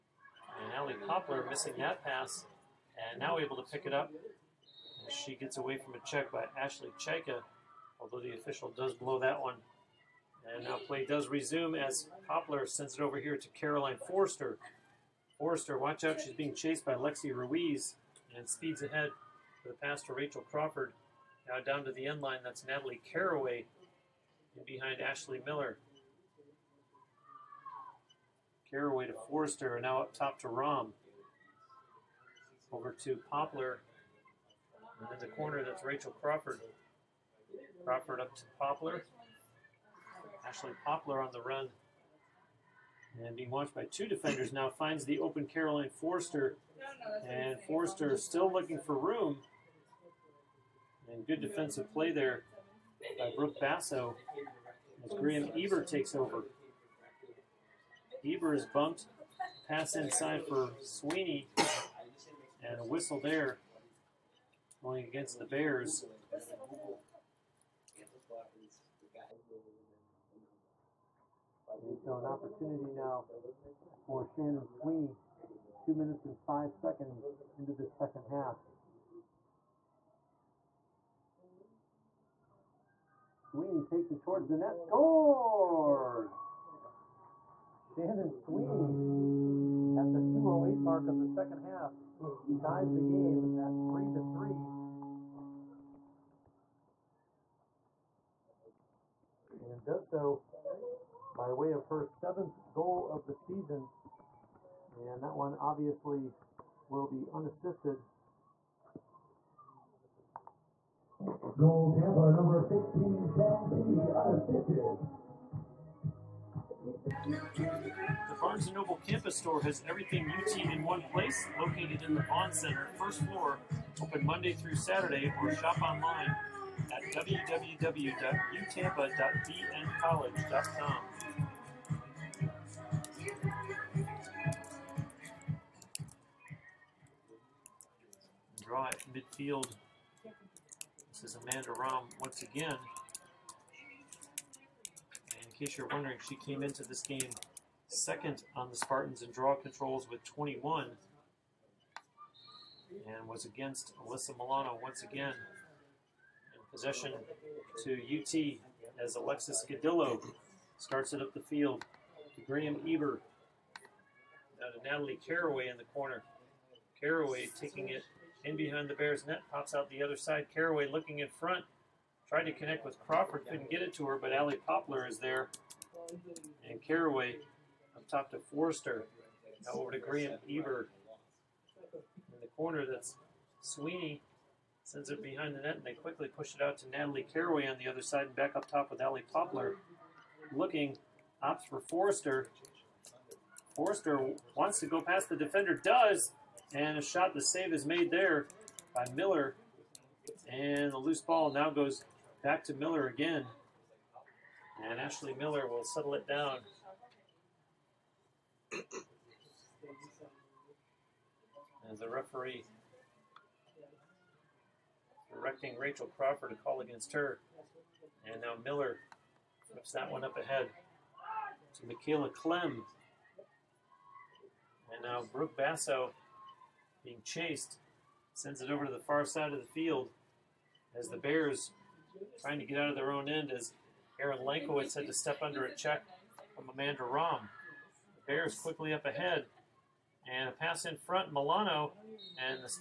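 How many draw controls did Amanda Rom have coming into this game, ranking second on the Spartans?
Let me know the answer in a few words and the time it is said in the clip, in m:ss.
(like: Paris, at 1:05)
21, at 2:30.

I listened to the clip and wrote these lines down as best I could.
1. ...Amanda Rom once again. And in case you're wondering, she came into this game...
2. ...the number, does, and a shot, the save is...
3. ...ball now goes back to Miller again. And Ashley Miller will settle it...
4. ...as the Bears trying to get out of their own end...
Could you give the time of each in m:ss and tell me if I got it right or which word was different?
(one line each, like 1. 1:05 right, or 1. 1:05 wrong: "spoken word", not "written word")
1. 2:21 right
2. 3:15 wrong: "defender", not "number"
3. 3:21 right
4. 3:50 right.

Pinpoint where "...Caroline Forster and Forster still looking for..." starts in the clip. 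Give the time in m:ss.
0:45.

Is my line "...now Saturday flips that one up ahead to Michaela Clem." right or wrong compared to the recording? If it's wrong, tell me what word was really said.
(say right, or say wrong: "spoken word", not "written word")
wrong: "Miller", not "Saturday".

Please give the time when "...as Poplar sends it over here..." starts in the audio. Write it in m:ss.
0:11.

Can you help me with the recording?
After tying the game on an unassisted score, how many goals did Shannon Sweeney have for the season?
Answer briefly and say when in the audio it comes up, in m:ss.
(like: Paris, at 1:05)
7, at 1:42.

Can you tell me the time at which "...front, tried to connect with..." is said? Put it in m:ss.
2:51.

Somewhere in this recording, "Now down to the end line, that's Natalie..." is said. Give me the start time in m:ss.
0:21.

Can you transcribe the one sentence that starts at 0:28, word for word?
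Caraway to Forrester, and now up top to Rom.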